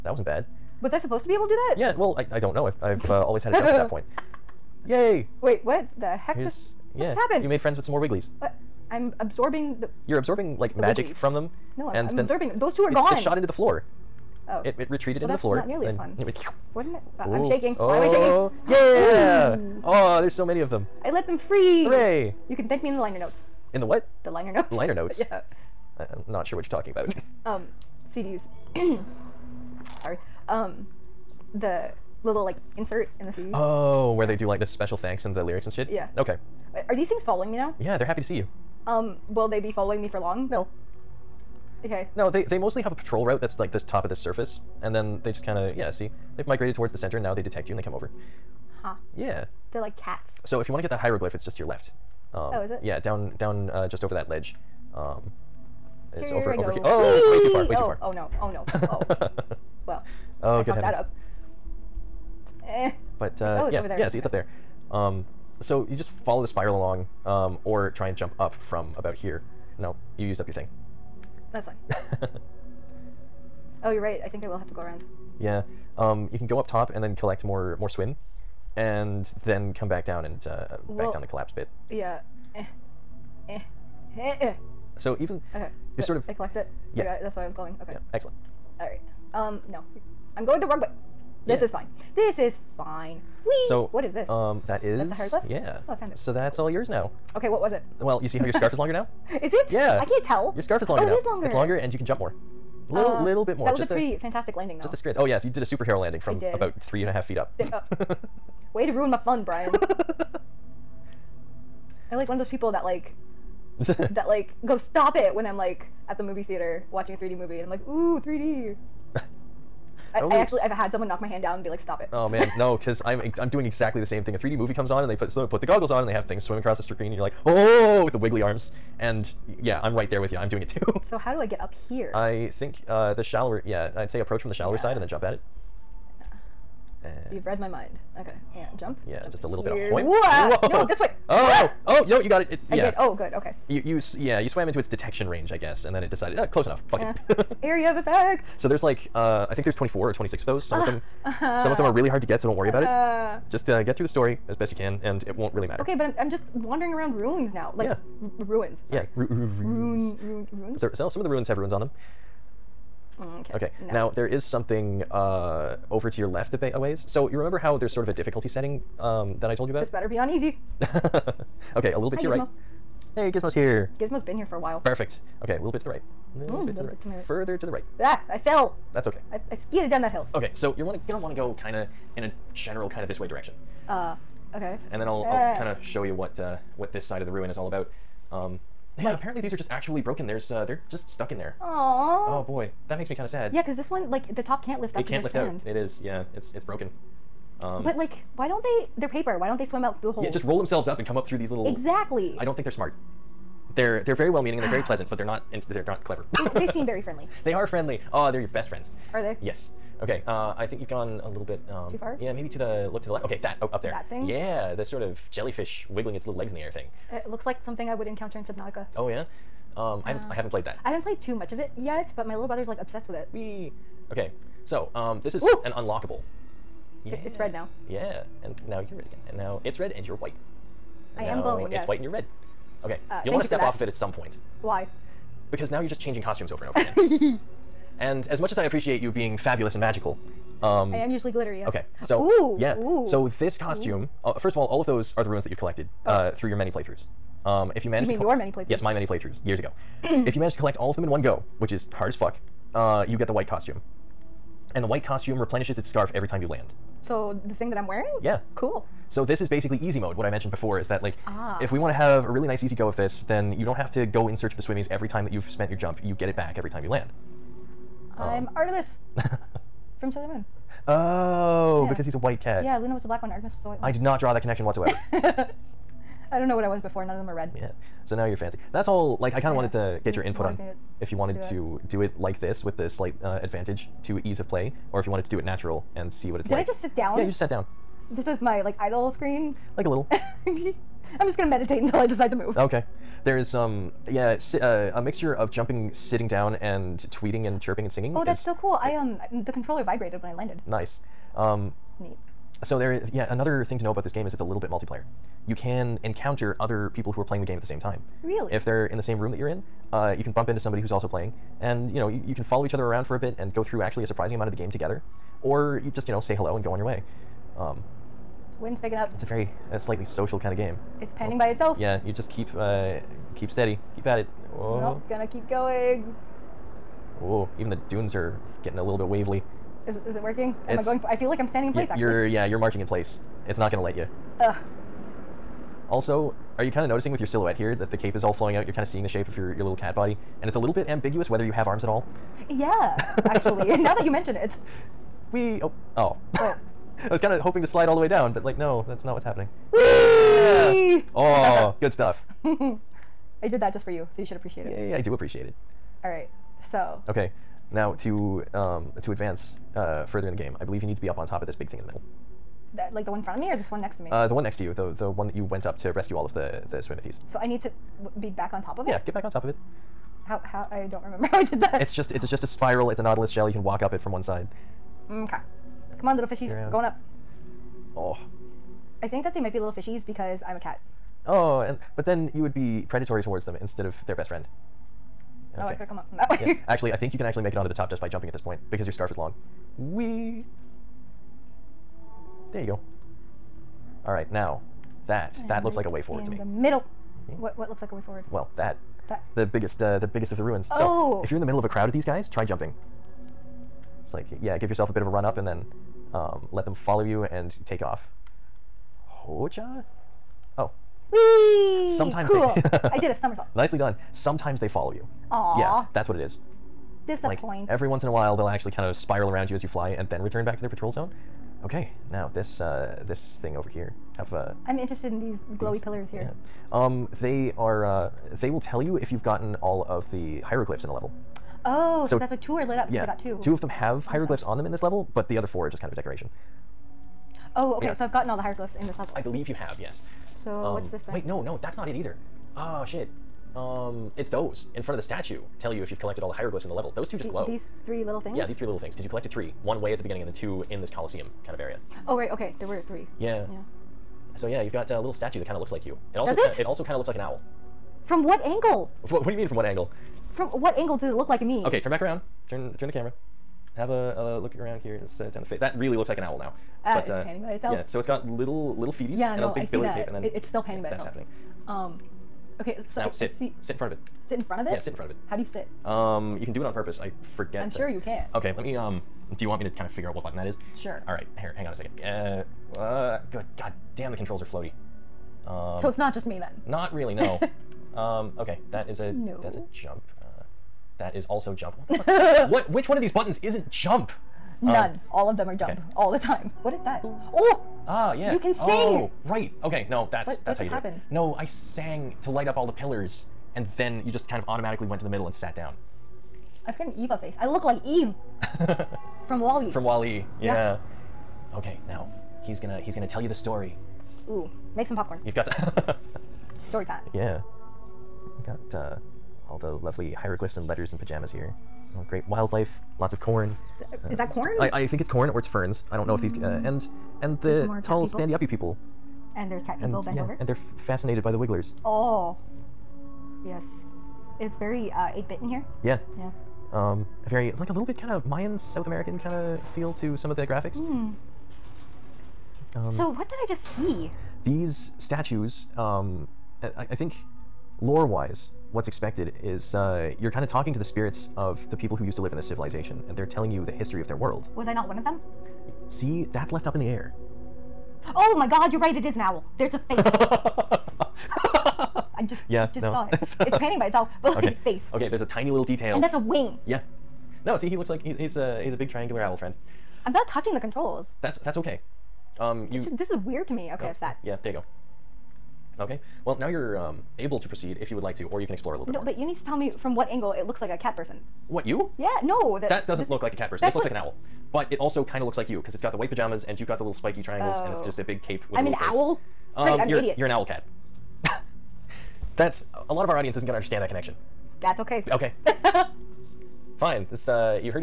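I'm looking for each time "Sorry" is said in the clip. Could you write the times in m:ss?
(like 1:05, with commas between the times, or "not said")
0:30, 2:38.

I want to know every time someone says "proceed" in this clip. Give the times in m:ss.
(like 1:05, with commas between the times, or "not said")
9:37.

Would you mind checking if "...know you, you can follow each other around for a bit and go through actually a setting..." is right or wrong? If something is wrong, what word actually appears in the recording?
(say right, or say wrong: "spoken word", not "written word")
wrong: "surprising", not "setting".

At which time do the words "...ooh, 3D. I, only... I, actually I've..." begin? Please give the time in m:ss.
1:57.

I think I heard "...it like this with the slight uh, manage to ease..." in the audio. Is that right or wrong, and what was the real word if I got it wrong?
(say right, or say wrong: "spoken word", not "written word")
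wrong: "advantage", not "manage".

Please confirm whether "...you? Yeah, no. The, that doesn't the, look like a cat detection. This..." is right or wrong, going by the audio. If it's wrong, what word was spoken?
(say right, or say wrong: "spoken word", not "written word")
wrong: "person", not "detection".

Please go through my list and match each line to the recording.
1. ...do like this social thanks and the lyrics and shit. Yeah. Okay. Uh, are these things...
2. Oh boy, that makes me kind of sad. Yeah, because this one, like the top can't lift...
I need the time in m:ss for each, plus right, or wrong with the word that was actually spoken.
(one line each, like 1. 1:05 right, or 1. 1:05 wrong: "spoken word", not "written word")
1. 0:34 wrong: "special", not "social"
2. 3:11 right.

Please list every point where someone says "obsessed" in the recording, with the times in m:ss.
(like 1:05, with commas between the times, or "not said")
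3:42.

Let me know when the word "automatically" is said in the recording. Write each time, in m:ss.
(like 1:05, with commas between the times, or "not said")
8:24.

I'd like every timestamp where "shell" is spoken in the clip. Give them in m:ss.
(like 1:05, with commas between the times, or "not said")
6:13.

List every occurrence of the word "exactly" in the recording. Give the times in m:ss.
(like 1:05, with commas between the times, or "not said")
2:03, 3:21.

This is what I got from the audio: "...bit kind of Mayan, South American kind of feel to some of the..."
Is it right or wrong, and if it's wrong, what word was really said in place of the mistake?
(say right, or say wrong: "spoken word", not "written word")
right.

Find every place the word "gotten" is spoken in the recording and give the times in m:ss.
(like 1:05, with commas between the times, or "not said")
7:09, 7:18.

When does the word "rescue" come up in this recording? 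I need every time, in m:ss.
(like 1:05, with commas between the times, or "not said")
6:05.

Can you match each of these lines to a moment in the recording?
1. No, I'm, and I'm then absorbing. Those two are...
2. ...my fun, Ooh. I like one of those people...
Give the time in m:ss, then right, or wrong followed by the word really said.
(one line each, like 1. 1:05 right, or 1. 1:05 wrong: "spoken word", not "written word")
1. 0:11 right
2. 1:49 wrong: "Brian", not "Ooh".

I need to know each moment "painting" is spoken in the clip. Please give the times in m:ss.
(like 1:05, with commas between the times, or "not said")
9:23.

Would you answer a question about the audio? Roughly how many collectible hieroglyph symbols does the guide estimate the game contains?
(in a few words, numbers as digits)
24 or 26.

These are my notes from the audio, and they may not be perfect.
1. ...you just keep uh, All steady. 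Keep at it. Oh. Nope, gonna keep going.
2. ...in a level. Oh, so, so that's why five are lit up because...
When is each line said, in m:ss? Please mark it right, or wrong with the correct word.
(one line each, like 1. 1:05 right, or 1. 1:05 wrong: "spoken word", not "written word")
1. 5:22 wrong: "Keep", not "All"
2. 7:10 wrong: "two", not "five".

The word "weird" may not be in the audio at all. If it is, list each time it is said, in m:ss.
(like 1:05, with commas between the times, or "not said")
9:33.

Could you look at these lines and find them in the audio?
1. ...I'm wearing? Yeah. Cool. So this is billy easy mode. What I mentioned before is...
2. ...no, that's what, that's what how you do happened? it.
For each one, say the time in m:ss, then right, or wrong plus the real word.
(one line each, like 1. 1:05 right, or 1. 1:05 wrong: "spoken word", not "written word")
1. 4:17 wrong: "basically", not "billy"
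2. 8:19 right.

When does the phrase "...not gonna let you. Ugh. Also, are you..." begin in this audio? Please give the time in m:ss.
5:33.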